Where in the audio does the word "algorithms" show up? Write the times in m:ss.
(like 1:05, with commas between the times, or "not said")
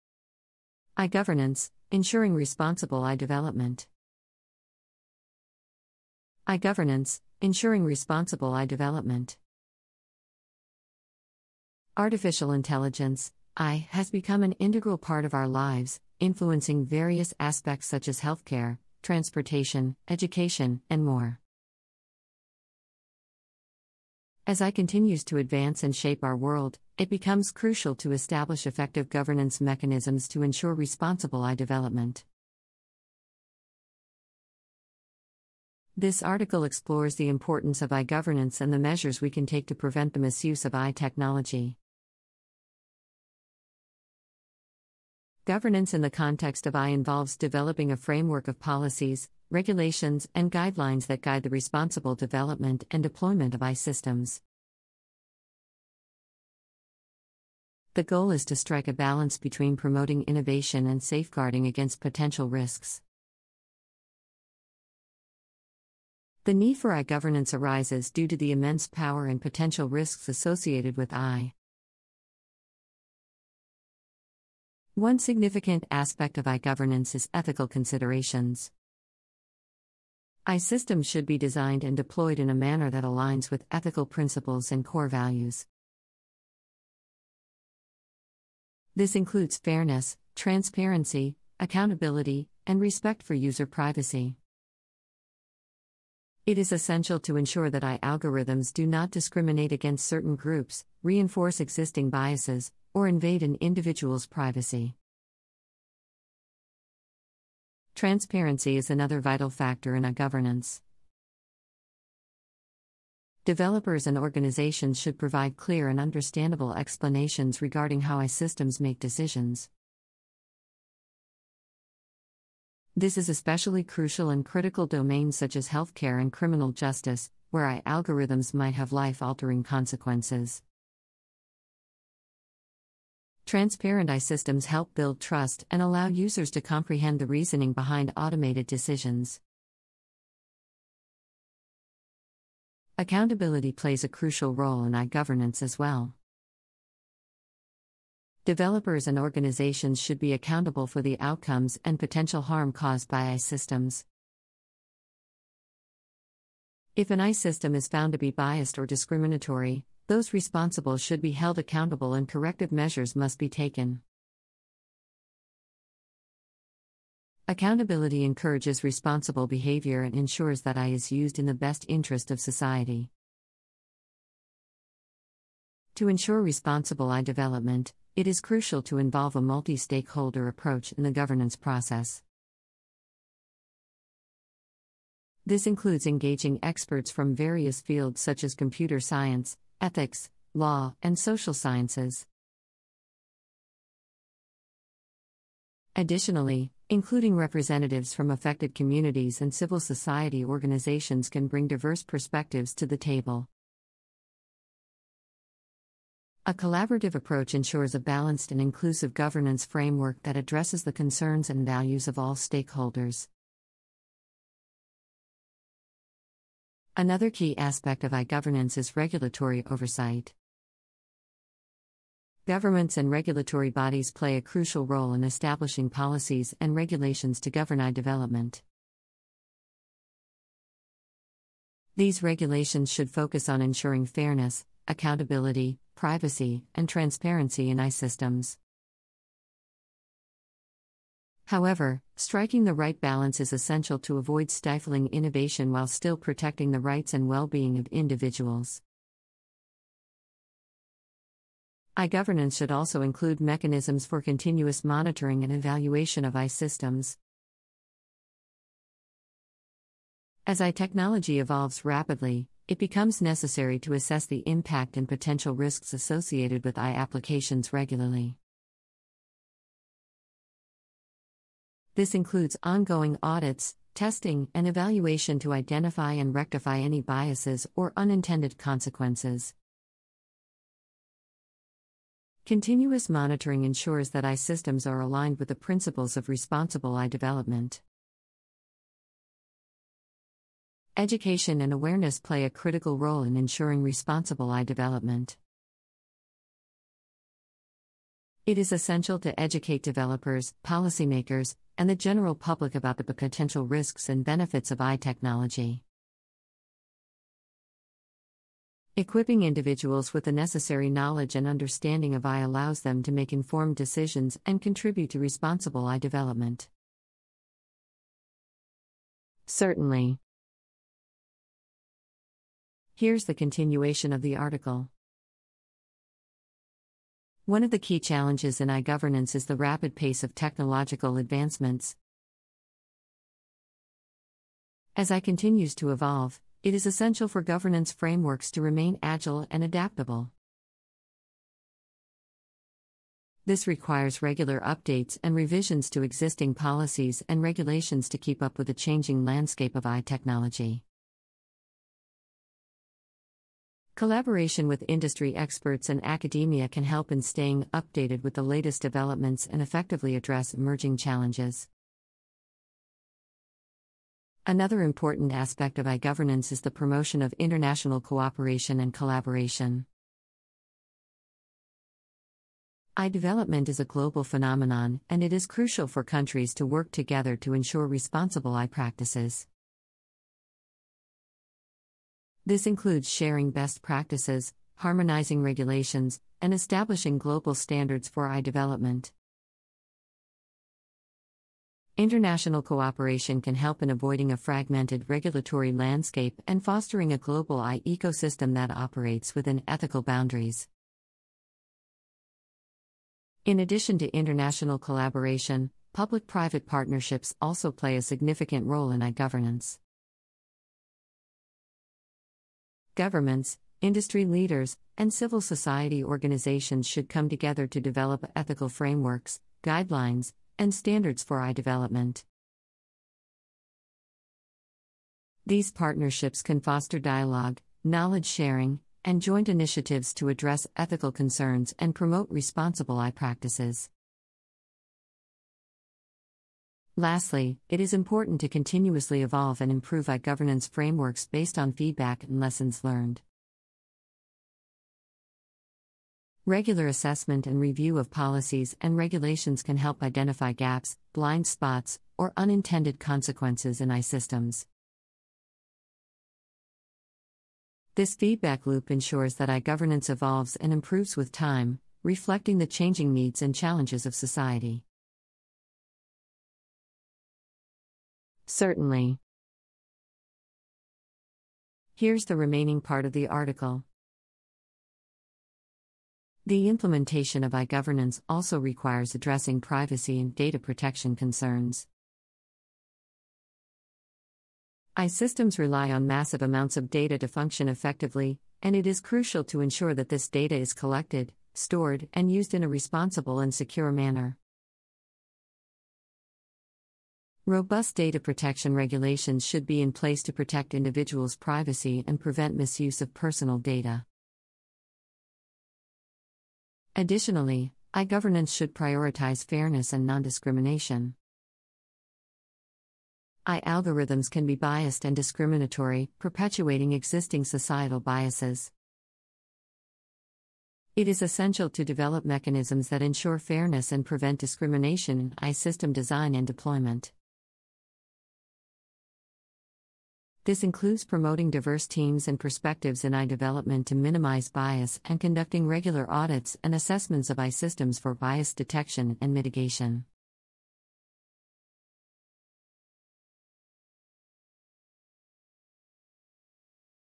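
1:38, 2:07, 8:33.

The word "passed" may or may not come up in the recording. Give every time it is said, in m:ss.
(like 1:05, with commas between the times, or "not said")
not said.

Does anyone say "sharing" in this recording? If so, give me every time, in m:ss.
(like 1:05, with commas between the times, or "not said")
6:23, 7:08.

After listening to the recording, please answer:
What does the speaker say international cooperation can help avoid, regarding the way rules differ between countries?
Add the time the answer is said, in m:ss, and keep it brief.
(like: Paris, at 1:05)
a fragmented regulatory landscape, at 6:34.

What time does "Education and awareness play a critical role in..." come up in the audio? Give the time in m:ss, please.
4:50.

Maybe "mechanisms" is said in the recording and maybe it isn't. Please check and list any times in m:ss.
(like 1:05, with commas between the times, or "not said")
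0:29, 4:13, 8:42.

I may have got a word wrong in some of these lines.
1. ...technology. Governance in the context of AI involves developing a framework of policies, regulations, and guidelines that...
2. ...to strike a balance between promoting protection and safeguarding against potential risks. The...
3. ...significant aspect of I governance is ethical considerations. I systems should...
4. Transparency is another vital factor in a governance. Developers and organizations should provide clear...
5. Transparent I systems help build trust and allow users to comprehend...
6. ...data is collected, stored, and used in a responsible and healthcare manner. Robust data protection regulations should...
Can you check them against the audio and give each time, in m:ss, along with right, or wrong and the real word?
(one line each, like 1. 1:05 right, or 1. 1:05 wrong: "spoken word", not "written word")
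1. 0:40 right
2. 0:58 wrong: "innovation", not "protection"
3. 1:15 right
4. 1:48 right
5. 2:13 right
6. 8:10 wrong: "secure", not "healthcare".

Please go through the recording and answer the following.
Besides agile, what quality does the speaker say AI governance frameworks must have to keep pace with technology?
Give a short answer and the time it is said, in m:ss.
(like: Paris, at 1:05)
adaptable, at 5:39.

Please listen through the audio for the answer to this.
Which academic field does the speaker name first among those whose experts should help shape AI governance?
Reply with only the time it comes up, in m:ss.
3:08.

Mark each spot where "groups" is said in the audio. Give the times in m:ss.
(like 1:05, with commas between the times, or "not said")
1:40.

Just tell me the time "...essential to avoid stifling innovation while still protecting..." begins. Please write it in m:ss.
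4:03.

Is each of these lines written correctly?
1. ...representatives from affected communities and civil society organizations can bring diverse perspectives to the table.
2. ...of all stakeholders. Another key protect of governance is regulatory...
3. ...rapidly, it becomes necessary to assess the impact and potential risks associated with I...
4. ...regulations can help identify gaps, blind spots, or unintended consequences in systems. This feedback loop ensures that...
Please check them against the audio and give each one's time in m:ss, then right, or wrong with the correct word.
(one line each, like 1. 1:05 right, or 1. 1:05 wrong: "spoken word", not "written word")
1. 3:17 right
2. 3:32 wrong: "aspect", not "protect"
3. 4:21 right
4. 7:28 right.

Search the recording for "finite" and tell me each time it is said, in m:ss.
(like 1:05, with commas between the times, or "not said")
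not said.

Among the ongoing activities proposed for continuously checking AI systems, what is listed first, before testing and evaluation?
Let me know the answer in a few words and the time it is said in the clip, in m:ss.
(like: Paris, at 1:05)
ongoing audits, at 4:32.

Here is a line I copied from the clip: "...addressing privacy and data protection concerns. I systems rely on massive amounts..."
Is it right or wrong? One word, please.
right.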